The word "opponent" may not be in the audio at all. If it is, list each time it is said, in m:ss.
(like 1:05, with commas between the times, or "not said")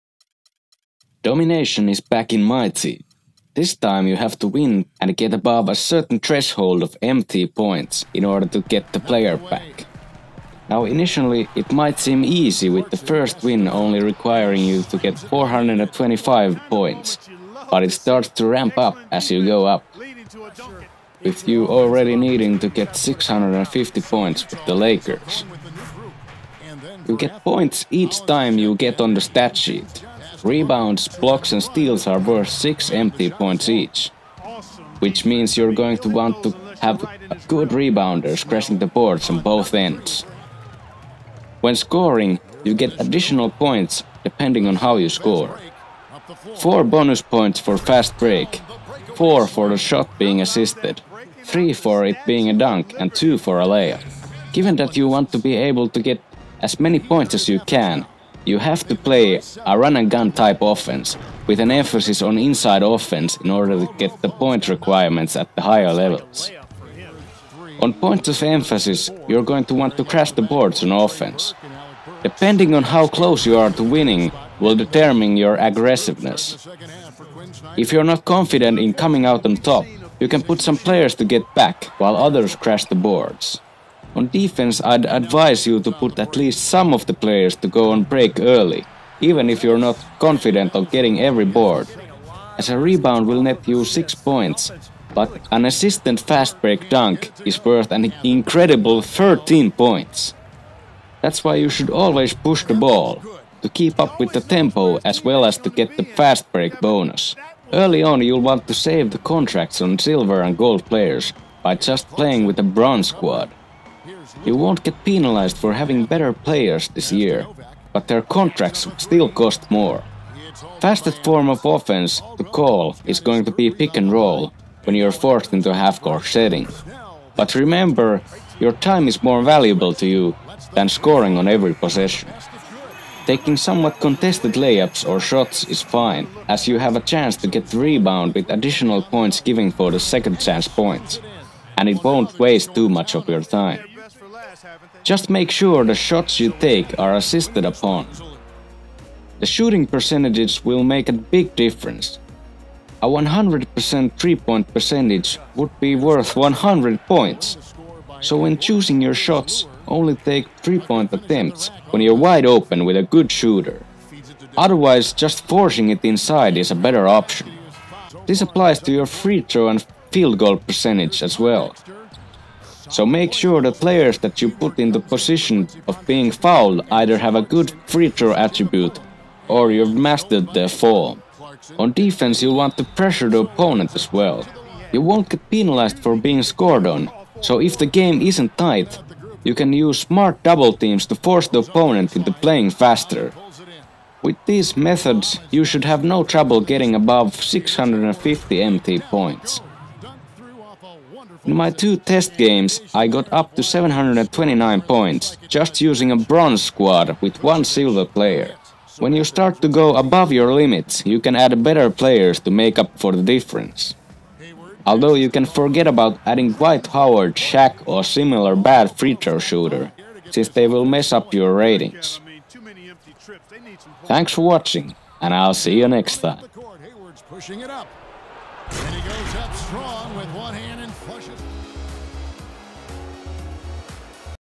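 3:03, 3:11.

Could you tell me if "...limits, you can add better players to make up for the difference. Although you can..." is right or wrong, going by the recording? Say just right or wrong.
right.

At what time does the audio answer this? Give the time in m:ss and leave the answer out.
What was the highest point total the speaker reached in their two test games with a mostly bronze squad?
3:23.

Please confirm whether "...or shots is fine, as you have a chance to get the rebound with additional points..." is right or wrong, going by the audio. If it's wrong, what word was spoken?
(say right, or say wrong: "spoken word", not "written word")
right.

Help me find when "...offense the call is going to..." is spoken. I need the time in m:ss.
2:01.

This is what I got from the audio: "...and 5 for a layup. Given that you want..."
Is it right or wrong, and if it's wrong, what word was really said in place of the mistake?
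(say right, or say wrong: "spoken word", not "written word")
wrong: "2", not "5".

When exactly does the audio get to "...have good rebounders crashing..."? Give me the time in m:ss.
0:36.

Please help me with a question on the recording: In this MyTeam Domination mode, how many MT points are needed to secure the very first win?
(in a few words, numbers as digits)
425.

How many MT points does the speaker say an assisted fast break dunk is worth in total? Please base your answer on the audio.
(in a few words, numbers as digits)
13.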